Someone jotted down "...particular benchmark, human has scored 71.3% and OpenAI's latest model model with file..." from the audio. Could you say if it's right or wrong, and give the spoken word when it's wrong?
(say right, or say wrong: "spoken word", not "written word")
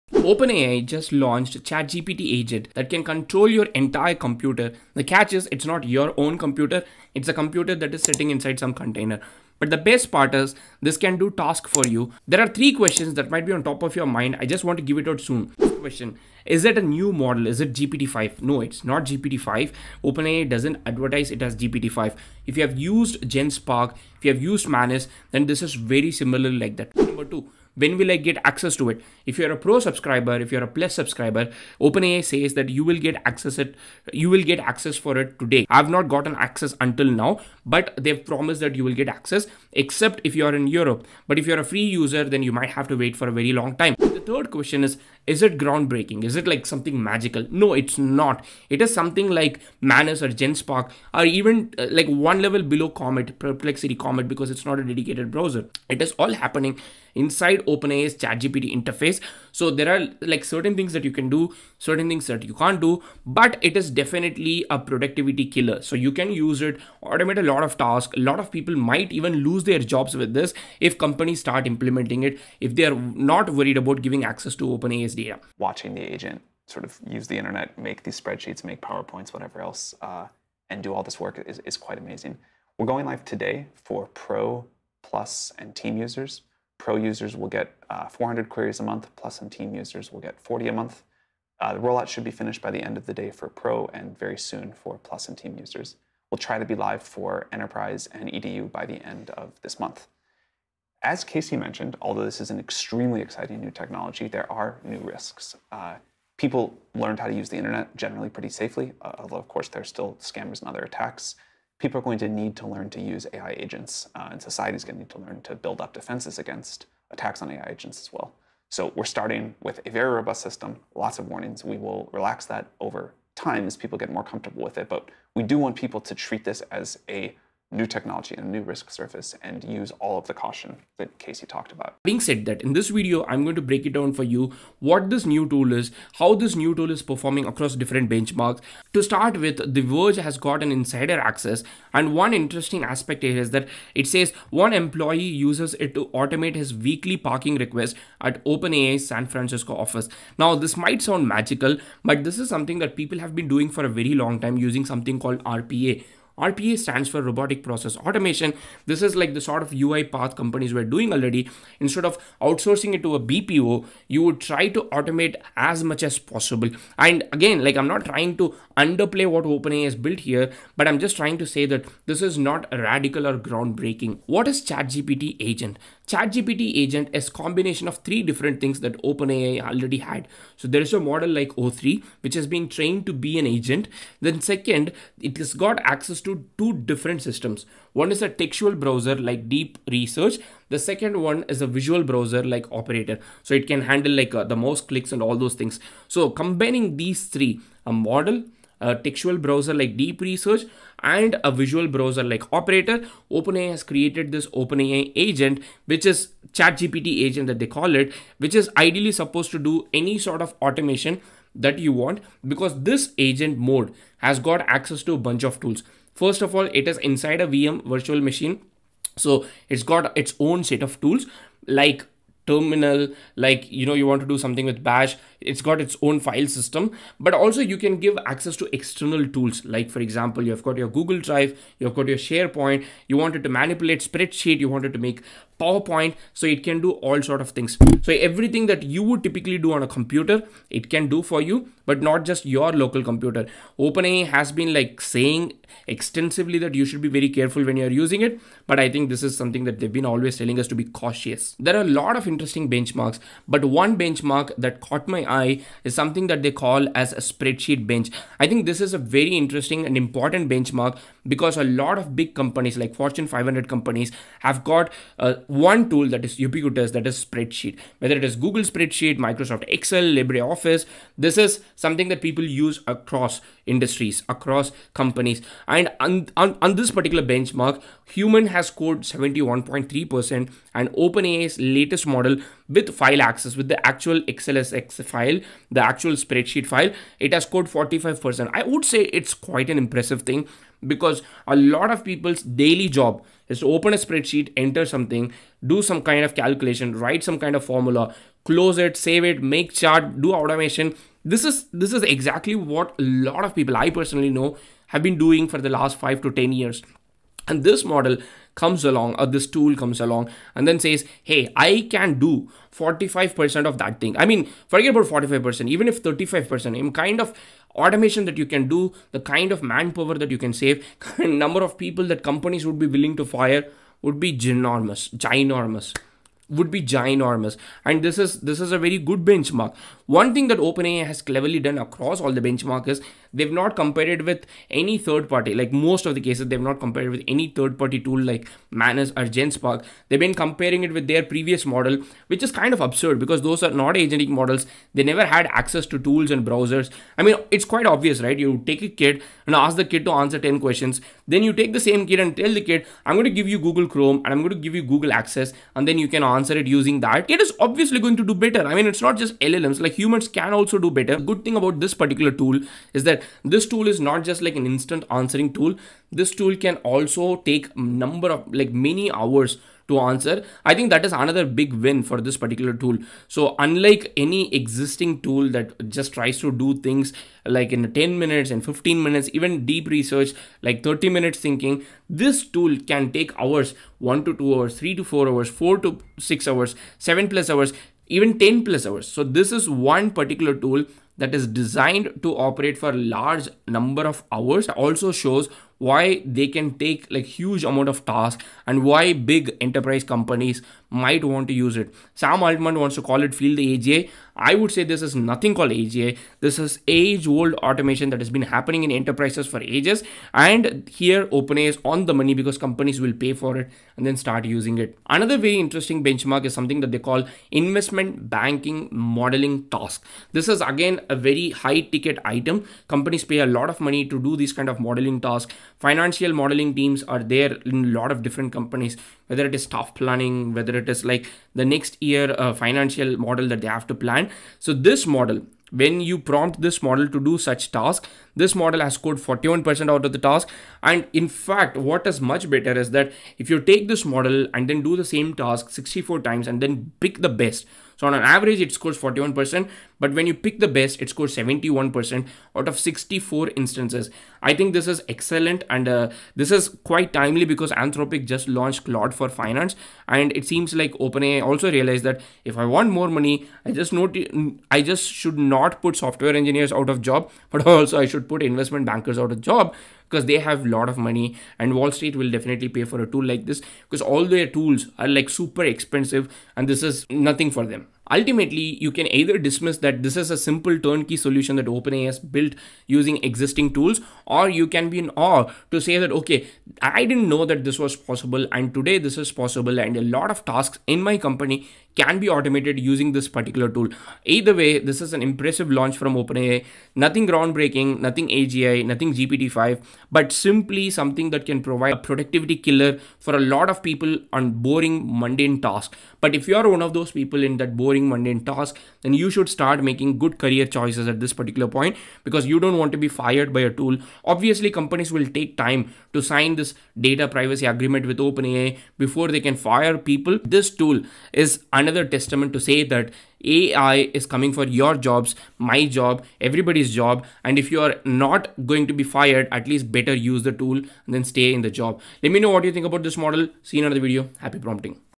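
right.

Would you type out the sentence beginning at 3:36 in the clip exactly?
First of all, it is inside a VM virtual machine.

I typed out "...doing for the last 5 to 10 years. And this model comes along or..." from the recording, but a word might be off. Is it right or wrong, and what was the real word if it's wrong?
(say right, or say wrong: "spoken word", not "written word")
right.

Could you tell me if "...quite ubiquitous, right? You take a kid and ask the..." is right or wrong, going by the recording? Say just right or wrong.
wrong.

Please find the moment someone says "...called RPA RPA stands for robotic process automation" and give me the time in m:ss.
2:35.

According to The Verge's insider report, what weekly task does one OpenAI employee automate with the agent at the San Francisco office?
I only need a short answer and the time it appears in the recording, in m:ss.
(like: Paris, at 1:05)
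Parking request, at 2:26.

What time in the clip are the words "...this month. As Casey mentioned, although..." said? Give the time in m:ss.
1:39.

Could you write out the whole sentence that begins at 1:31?
Uh, the rollout should be finished by the end of the day for Pro and very soon for Plus and Team users.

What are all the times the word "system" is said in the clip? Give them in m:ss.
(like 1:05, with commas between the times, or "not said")
2:00, 3:07, 3:46.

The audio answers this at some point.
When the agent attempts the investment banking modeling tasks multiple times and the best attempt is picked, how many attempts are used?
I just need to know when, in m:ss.
7:25.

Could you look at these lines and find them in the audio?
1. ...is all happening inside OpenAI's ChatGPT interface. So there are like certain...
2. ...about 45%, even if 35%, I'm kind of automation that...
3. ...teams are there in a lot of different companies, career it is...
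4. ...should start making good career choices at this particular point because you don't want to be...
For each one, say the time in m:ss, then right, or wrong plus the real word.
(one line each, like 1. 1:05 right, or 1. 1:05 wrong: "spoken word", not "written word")
1. 0:56 right
2. 5:14 right
3. 7:06 wrong: "whether", not "career"
4. 8:29 right.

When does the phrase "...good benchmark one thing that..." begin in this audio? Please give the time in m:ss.
5:28.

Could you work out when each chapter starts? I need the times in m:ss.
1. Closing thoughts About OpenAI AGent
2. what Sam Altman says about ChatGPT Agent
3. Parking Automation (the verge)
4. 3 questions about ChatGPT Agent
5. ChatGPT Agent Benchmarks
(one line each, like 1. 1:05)
1. 7:58
2. 1:15
3. 2:17
4. 0:12
5. 4:13.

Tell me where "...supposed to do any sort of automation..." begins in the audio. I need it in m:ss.
3:29.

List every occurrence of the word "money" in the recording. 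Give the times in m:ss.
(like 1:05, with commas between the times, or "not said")
6:52, 7:03, 7:43, 7:50.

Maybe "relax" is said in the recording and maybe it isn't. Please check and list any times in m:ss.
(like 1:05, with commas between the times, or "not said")
2:02.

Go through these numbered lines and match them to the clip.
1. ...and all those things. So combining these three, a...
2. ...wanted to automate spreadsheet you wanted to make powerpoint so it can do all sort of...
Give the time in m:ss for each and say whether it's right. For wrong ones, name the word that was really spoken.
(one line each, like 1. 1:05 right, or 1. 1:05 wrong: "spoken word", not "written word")
1. 3:15 right
2. 3:53 wrong: "manipulate", not "automate".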